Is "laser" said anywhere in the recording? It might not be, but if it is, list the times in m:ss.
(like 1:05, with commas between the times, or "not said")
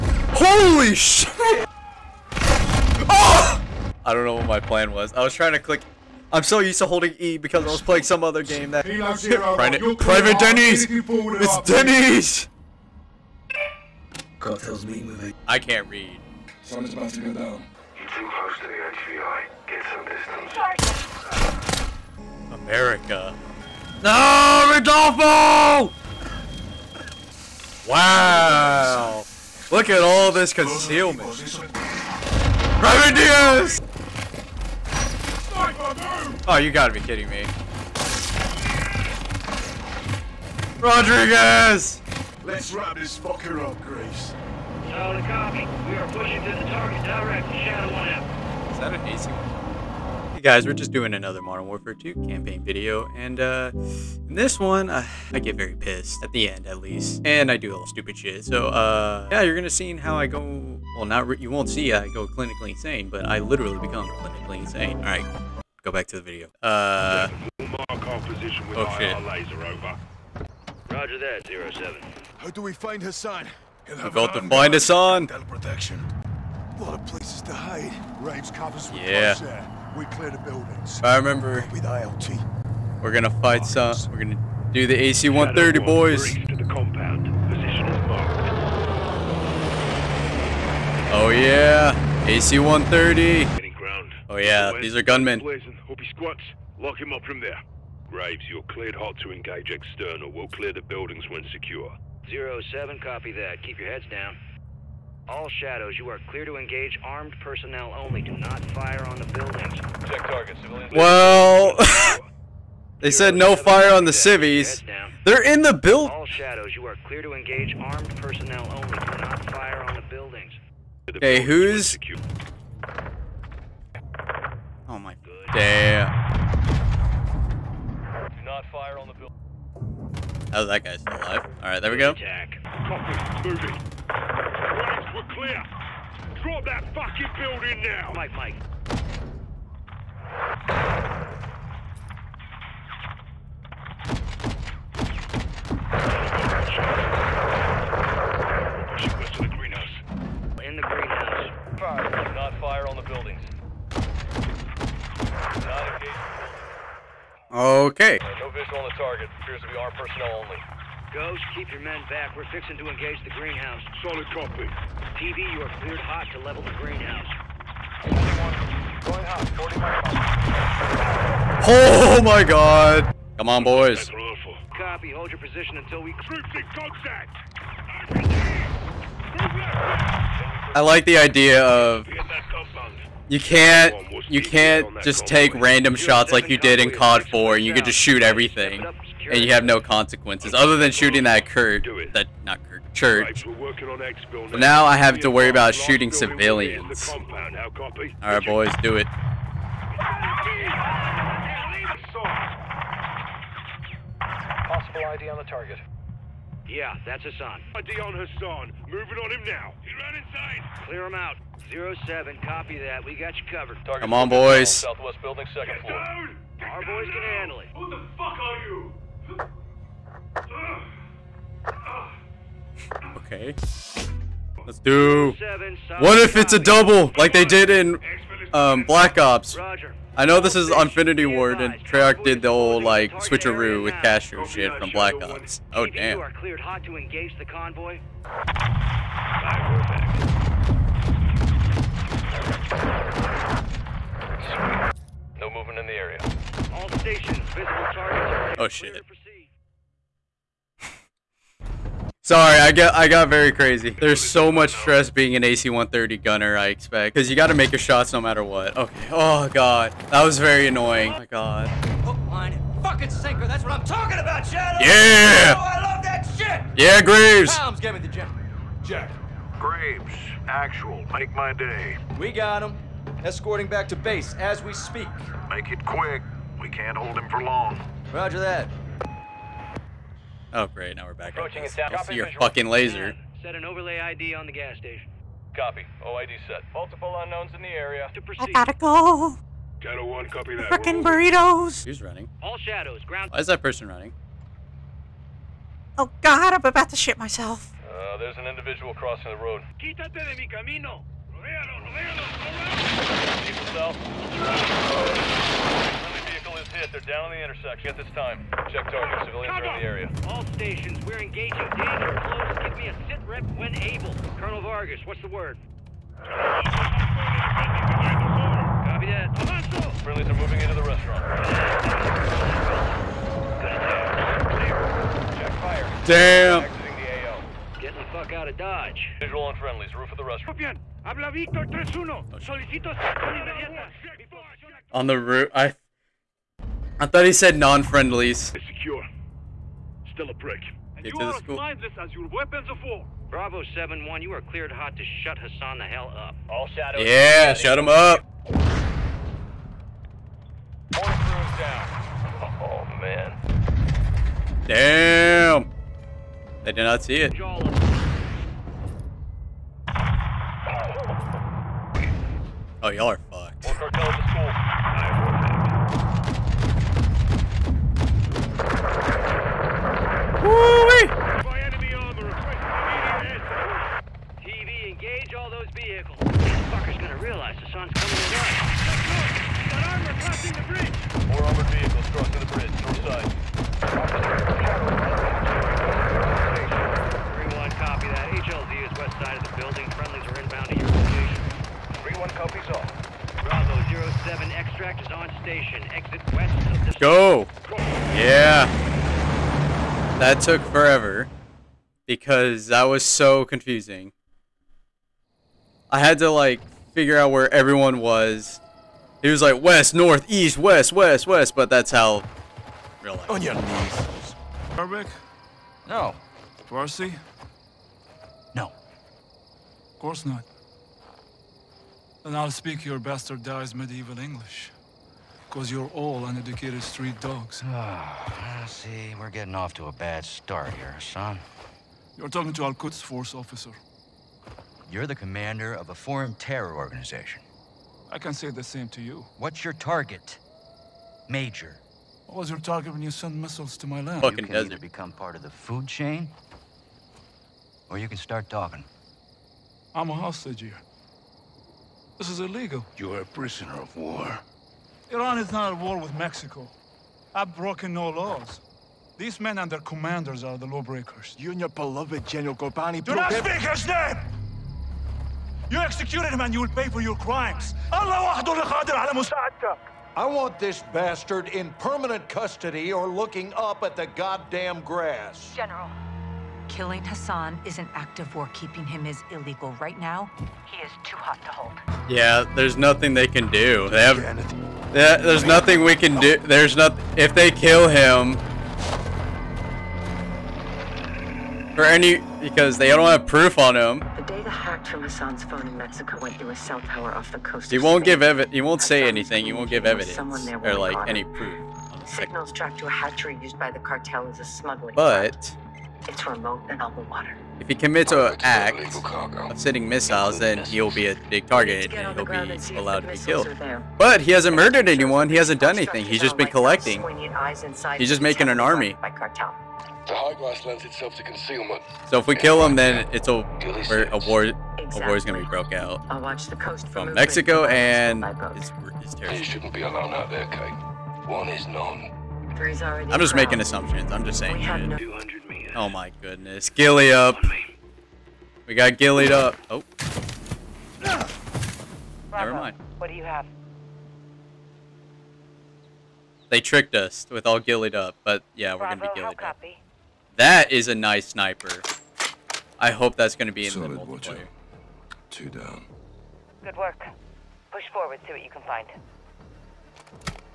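1:09, 4:42.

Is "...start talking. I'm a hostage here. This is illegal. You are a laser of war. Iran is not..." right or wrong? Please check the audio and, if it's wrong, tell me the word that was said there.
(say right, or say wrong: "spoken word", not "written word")
wrong: "prisoner", not "laser".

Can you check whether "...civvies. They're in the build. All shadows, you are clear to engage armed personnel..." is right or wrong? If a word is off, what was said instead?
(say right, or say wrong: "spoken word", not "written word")
right.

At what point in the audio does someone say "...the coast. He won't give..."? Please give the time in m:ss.
8:17.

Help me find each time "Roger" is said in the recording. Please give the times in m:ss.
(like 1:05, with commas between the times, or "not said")
1:10, 4:38.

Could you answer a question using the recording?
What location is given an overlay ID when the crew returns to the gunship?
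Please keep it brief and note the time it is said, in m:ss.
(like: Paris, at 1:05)
the gas station, at 4:43.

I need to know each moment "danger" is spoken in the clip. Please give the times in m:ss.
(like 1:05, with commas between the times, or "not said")
5:11.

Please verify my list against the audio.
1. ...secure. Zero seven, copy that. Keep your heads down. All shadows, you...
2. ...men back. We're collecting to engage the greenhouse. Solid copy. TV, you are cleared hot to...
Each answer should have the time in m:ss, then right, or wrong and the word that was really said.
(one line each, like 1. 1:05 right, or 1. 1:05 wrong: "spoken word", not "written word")
1. 1:41 right
2. 2:41 wrong: "fixing", not "collecting".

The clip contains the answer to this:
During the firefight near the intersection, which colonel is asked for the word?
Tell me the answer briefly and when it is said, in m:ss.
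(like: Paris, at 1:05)
Colonel Vargas, at 5:14.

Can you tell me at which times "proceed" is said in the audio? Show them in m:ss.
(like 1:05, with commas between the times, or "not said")
4:48.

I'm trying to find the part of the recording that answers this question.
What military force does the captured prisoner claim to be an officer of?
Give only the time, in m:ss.
7:12.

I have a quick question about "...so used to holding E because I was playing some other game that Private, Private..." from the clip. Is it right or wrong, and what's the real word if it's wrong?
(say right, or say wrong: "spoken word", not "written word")
right.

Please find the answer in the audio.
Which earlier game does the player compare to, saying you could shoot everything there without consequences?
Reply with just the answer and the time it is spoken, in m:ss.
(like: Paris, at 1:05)
COD 4, at 3:06.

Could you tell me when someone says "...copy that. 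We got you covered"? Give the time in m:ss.
3:32.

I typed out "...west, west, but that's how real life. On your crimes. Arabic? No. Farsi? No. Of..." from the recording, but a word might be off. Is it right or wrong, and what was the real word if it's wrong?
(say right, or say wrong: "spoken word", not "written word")
wrong: "knees", not "crimes".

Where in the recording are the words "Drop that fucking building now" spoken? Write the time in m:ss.
2:16.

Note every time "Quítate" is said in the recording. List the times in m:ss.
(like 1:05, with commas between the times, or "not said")
4:59.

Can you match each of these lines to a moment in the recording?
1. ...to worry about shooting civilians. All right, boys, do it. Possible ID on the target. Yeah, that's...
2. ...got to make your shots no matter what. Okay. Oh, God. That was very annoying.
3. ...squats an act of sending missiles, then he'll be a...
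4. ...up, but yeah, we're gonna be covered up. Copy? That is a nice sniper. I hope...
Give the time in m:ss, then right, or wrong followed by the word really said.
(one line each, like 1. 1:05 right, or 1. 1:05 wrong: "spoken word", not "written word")
1. 3:15 right
2. 4:17 right
3. 8:27 wrong: "commits", not "squats"
4. 9:07 wrong: "ghillied", not "covered".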